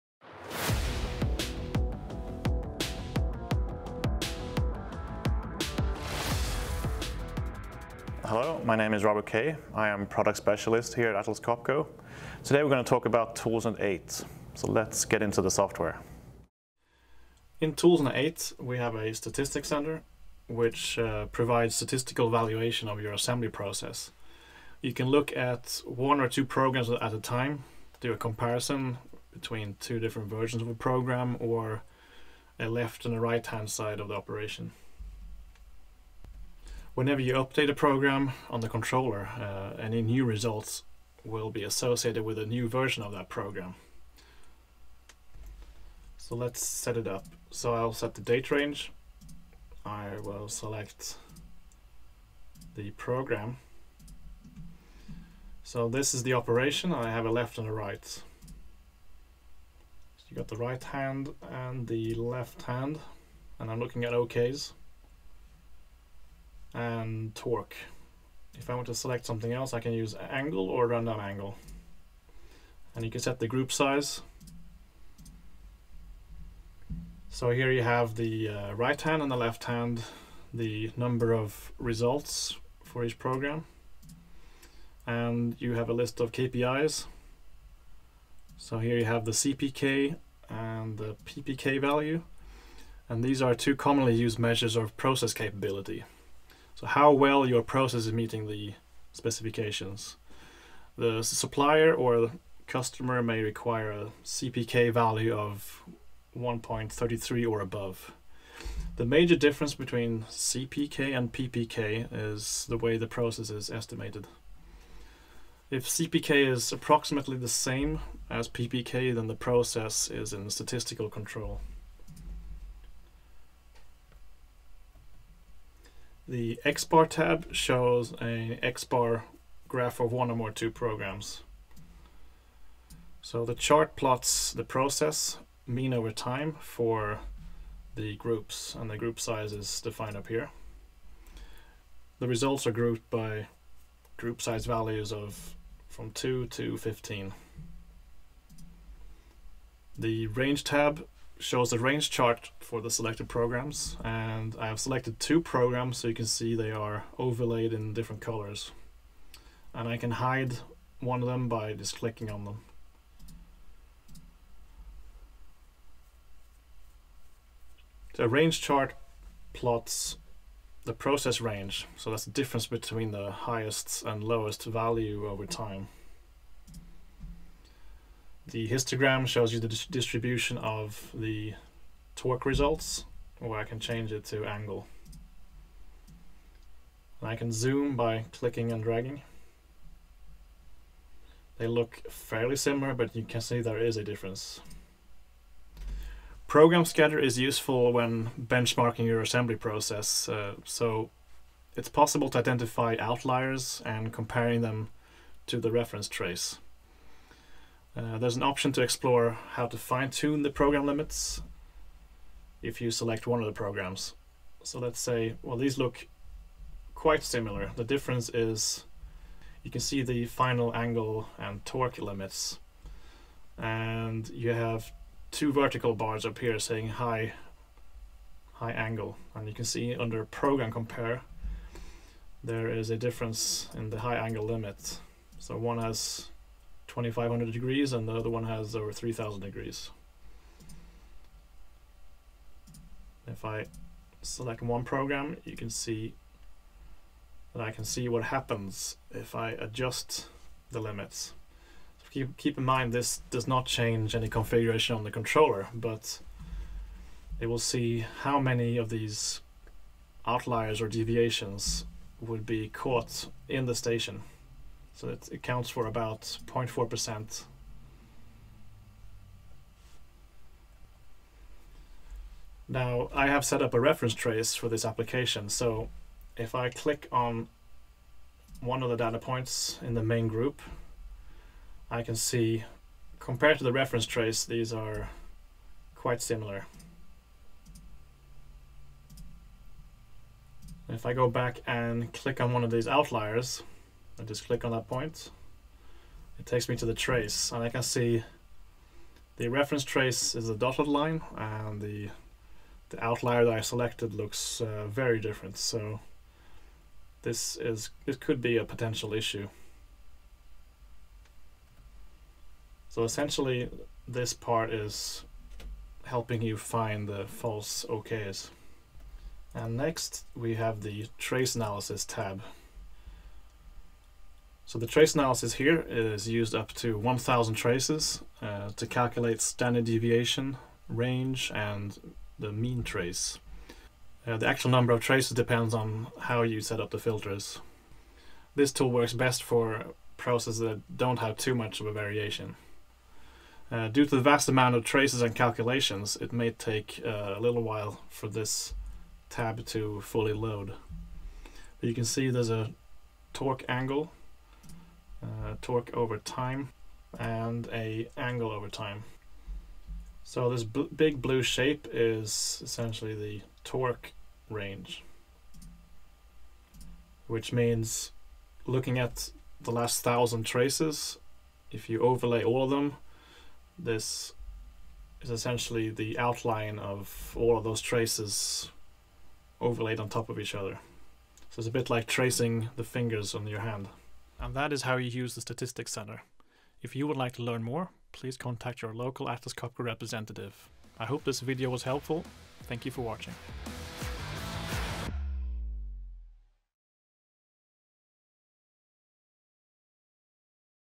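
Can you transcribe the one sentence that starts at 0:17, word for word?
In ToolsNet 8, we have a statistics center which uh, provides statistical valuation of your assembly process.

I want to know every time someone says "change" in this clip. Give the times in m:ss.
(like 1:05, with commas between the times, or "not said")
3:03, 4:13.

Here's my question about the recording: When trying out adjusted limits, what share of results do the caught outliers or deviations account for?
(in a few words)
0.4%.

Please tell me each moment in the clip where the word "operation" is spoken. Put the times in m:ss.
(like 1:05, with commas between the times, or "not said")
0:34, 0:56.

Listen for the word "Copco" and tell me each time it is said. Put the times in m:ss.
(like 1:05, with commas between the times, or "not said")
0:11, 6:29.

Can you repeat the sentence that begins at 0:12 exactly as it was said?
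Today we're going to talk about ToolsNet 8.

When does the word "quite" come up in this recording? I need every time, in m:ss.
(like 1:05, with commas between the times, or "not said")
3:36, 4:45.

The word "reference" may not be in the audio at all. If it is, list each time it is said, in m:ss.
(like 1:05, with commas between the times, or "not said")
3:25, 4:33, 4:43, 4:59.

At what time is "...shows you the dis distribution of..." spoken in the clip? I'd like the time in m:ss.
2:59.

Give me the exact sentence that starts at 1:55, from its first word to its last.
If CPK is approximately the same as PPK, then the process is in statistical control.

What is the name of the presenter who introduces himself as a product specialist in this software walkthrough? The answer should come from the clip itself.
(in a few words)
Robert Kay.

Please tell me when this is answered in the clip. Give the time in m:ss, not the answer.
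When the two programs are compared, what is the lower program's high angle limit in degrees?
3:56.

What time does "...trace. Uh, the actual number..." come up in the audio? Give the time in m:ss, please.
5:32.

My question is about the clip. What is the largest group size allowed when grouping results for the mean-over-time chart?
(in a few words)
15.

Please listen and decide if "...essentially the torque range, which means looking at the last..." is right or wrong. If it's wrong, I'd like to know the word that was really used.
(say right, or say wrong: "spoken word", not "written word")
right.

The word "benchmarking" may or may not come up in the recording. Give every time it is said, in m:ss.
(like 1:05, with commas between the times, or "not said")
3:18.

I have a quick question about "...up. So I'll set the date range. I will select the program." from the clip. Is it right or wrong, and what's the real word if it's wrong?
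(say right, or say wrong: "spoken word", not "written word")
right.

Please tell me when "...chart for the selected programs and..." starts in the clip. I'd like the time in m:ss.
2:32.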